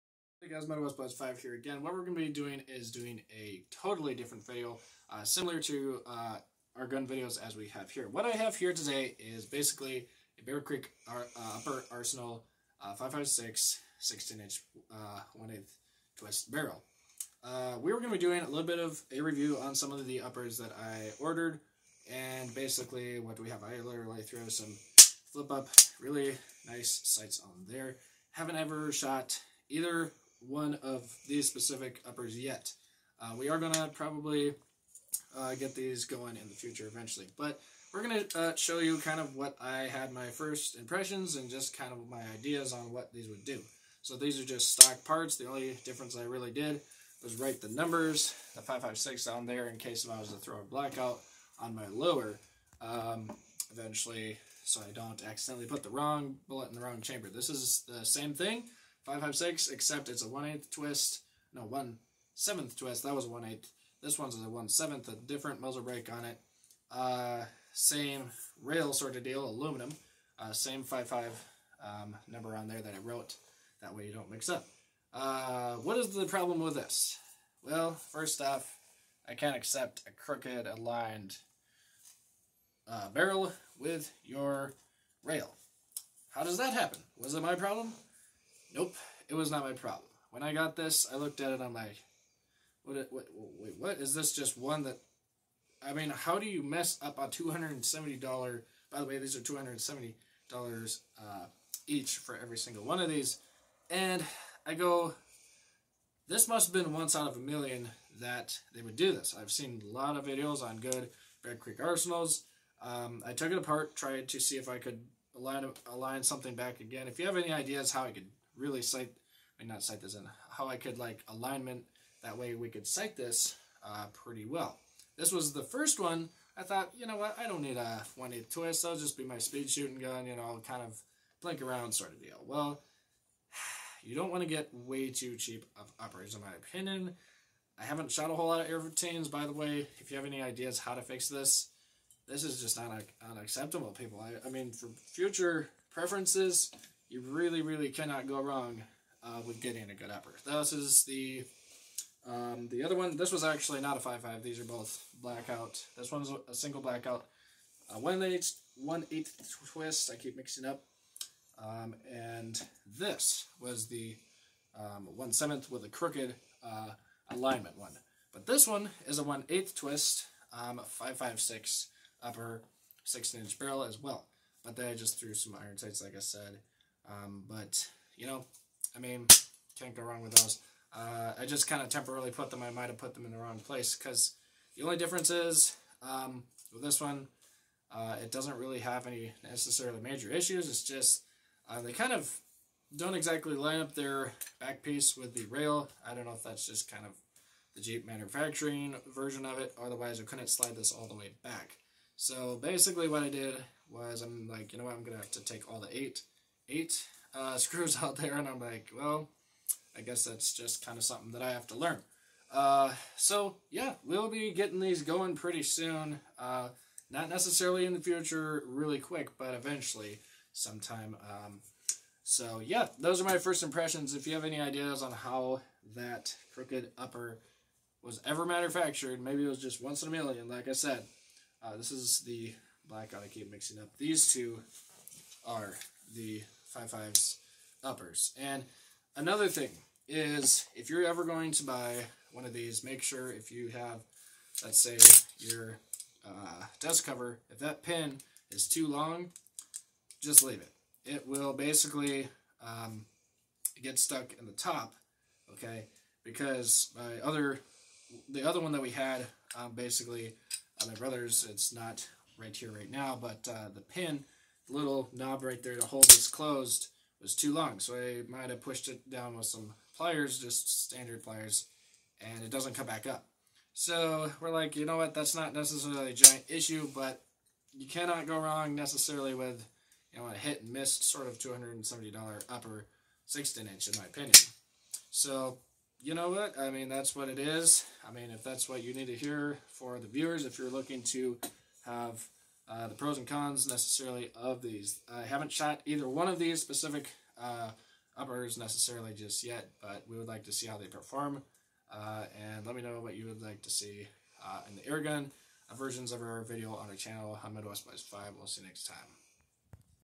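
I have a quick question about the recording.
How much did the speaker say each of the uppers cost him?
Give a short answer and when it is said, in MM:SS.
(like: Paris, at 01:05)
$270, at 01:37.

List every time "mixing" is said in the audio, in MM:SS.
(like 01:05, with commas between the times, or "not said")
02:40, 03:53.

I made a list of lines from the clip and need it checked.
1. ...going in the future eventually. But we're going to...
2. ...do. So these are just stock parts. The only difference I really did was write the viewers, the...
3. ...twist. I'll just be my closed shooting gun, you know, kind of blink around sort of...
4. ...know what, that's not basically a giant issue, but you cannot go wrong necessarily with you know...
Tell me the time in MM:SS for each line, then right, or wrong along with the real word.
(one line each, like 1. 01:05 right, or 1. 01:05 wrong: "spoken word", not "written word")
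1. 00:36 right
2. 00:43 wrong: "numbers", not "viewers"
3. 02:08 wrong: "speed", not "closed"
4. 04:34 wrong: "necessarily", not "basically".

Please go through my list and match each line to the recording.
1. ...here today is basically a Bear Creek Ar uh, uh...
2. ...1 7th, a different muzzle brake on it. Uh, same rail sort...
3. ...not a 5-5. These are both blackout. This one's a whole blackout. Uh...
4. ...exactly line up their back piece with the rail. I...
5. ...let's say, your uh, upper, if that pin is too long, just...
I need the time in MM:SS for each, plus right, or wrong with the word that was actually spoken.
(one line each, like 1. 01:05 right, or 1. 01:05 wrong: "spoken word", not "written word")
1. 00:08 right
2. 01:04 right
3. 02:33 wrong: "single", not "whole"
4. 03:13 right
5. 04:04 wrong: "cover", not "upper".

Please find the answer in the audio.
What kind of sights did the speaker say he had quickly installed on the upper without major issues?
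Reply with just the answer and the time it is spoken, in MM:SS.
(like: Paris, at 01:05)
iron sights, at 02:55.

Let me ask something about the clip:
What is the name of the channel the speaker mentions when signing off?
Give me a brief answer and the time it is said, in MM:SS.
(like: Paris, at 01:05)
Midwest Buzz 5, at 05:07.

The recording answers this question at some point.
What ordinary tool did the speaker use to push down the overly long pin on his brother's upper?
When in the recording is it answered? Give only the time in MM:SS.
04:30.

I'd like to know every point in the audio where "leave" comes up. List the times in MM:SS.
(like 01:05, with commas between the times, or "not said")
04:10.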